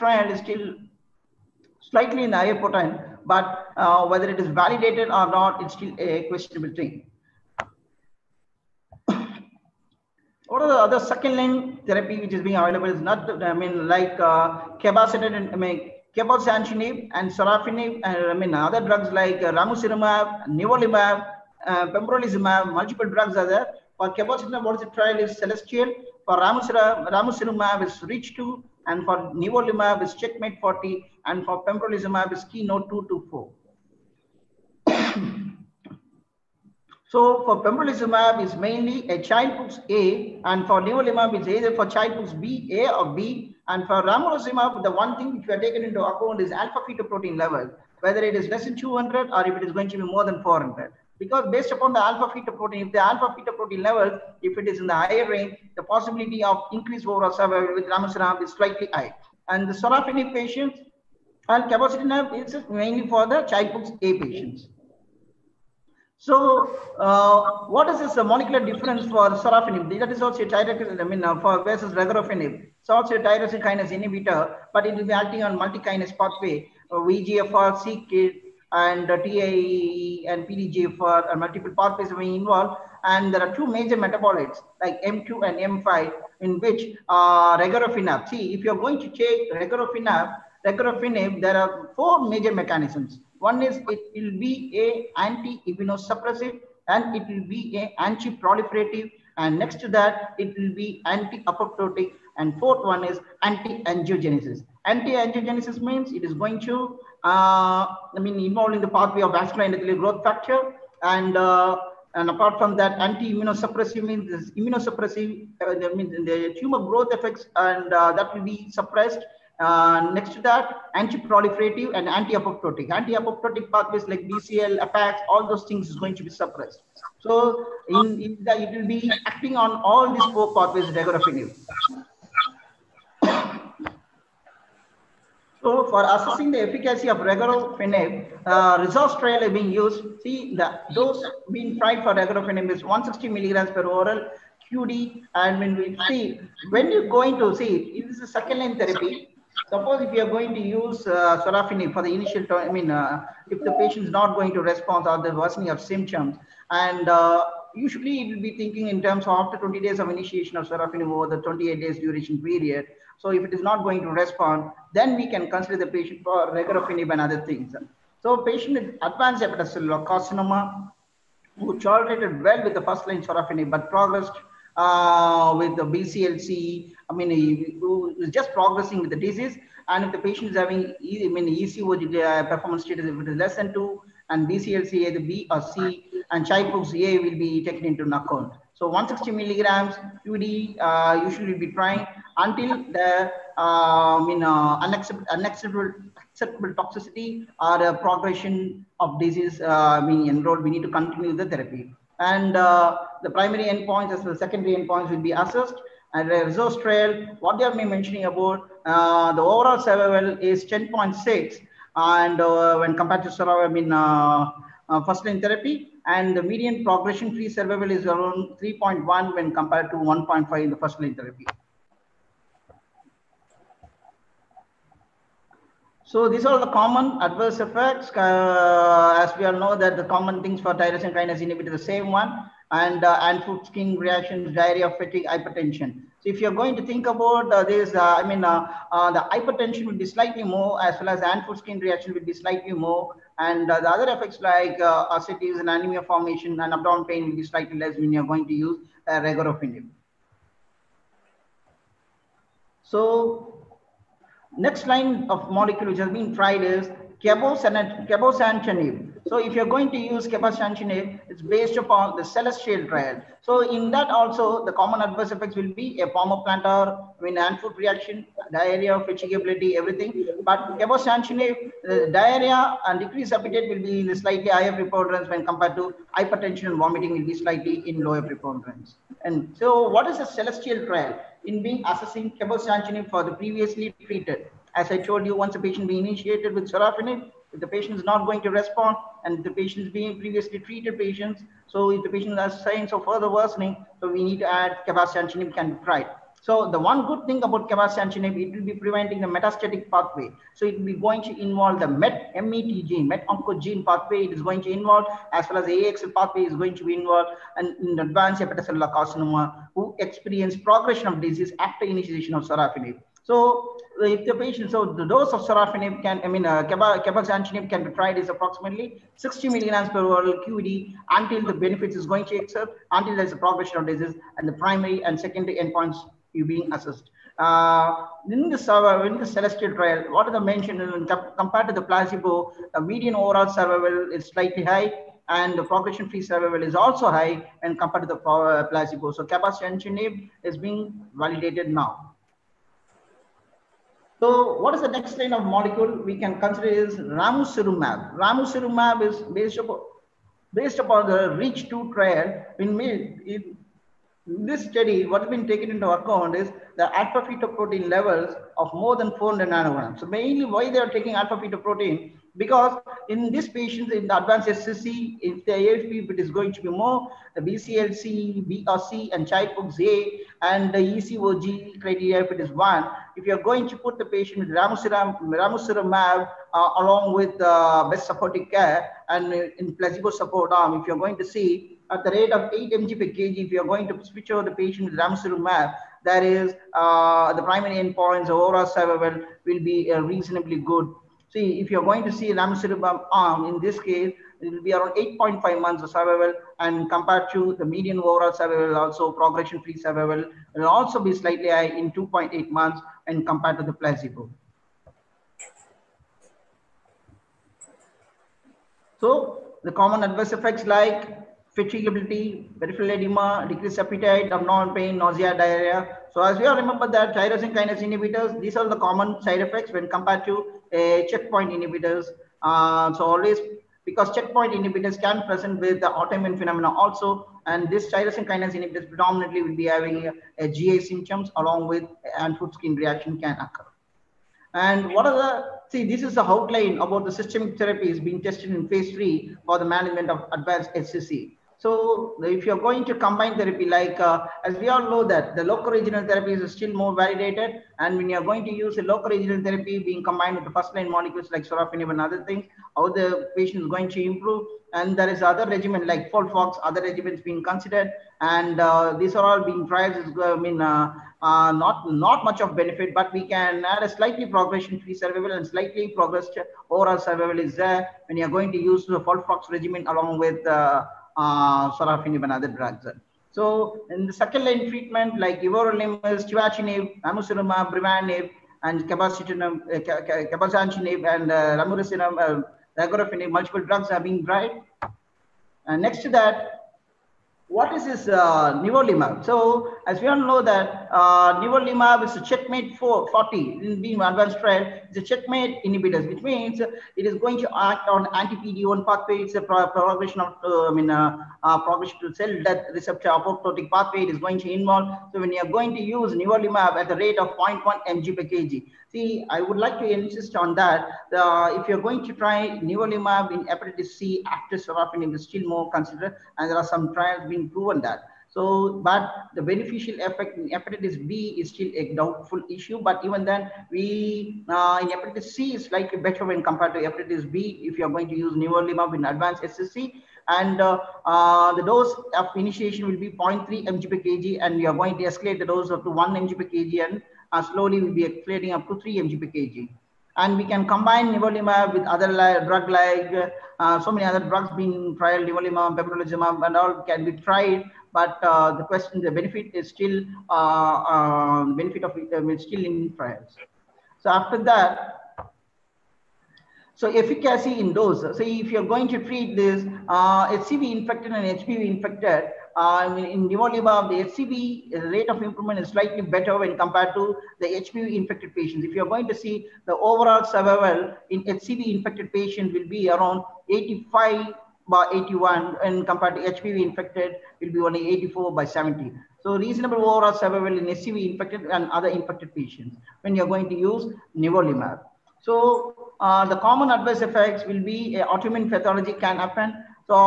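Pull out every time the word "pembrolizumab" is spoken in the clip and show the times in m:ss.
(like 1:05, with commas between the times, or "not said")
0:21, 0:31, 0:37, 9:05.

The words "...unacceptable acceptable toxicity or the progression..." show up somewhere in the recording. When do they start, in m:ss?
3:14.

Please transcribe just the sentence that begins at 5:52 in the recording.
In, in this study, what has been taken into account is the alpha fetoprotein levels of more than 400 nanograms.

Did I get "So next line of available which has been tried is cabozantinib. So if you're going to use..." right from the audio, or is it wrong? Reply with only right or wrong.
wrong.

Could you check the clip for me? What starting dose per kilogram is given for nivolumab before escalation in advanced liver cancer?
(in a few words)
0.3 mg/kg.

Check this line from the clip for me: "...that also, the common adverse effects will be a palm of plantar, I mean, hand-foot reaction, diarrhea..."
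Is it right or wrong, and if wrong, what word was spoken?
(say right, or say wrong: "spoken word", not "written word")
right.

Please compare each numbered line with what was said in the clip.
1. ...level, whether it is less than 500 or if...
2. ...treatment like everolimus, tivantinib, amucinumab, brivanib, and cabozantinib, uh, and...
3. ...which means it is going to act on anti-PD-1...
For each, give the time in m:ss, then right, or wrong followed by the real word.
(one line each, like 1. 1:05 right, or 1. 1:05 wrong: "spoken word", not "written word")
1. 0:47 wrong: "200", not "500"
2. 7:54 right
3. 8:16 right.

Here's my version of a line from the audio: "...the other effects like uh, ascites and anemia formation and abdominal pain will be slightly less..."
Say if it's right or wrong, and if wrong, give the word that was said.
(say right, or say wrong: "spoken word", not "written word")
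right.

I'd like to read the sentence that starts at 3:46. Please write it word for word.
So these are the common adverse effects.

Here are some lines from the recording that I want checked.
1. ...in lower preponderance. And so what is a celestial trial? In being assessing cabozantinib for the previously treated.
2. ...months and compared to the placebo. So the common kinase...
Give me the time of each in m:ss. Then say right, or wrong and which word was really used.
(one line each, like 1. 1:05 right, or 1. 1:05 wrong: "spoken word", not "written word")
1. 4:37 right
2. 6:42 wrong: "adverse", not "kinase".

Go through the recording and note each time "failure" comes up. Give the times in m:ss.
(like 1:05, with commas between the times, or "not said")
not said.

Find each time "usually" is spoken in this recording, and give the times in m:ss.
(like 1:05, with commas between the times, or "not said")
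2:37, 3:11.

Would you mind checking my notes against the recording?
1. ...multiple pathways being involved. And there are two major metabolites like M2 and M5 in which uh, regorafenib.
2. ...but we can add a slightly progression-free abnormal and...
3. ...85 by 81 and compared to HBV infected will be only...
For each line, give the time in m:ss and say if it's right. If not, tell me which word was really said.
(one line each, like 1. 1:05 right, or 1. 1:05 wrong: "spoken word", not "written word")
1. 1:21 right
2. 7:42 wrong: "survival", not "abnormal"
3. 9:33 right.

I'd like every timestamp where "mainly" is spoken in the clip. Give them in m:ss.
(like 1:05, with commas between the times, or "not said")
0:38, 1:02, 6:00.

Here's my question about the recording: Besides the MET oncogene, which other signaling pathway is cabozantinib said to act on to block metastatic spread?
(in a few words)
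AXL.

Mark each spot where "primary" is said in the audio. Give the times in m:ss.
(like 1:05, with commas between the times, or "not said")
3:23, 5:24, 6:27.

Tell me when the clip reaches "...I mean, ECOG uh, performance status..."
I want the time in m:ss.
3:01.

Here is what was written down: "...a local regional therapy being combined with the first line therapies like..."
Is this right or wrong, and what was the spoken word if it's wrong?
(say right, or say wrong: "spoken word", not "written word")
wrong: "molecules", not "therapies".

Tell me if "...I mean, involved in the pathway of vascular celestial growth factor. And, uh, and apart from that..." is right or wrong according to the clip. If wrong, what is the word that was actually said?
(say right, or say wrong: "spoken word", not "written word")
wrong: "endothelial", not "celestial".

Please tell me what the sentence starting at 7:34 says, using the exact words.
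And there is other regimen like Folfox, other regimens being considered.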